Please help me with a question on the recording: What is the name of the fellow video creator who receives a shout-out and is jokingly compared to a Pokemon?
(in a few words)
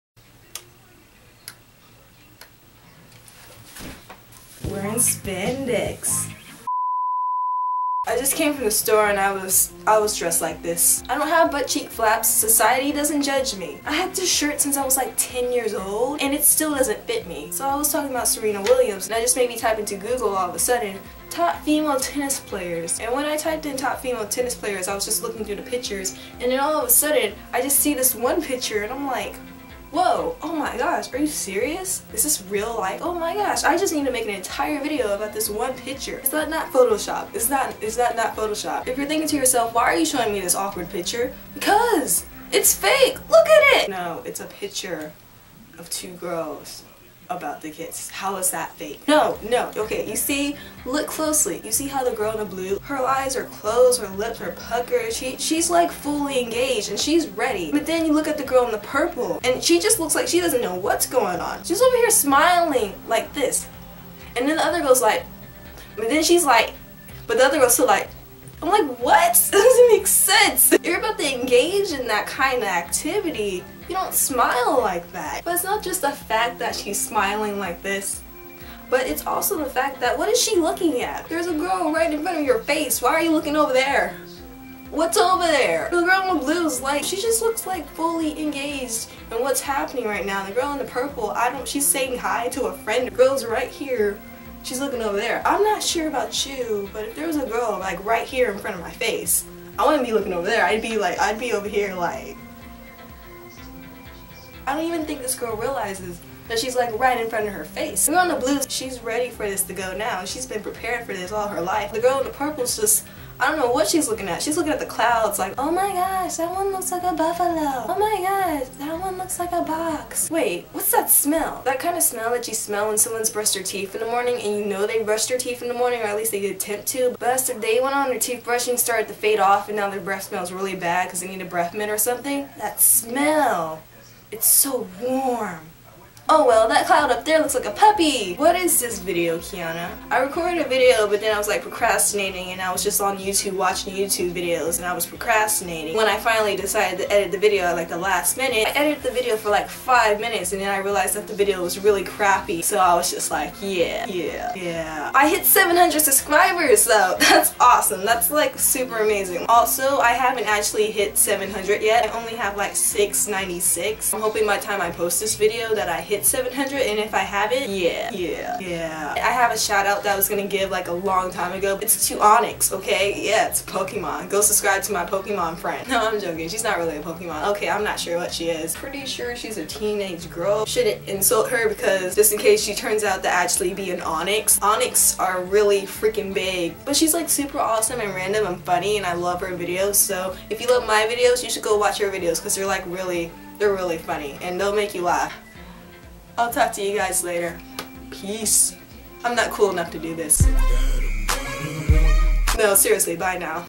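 Onyx.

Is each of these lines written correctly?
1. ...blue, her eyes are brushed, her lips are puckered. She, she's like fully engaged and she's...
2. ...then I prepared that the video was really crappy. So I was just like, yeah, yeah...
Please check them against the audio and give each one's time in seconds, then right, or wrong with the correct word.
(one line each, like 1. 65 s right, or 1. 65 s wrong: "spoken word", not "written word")
1. 52 s wrong: "closed", not "brushed"
2. 150 s wrong: "realized", not "prepared".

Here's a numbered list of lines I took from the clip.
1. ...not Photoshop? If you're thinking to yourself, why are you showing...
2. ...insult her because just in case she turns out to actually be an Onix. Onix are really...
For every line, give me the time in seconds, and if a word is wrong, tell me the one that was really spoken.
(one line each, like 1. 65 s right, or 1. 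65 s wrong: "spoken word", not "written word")
1. 38 s right
2. 181 s right.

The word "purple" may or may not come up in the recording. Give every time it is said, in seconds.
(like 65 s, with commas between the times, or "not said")
58 s, 90 s, 112 s.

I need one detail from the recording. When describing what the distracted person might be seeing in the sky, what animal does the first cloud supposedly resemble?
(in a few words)
Buffalo.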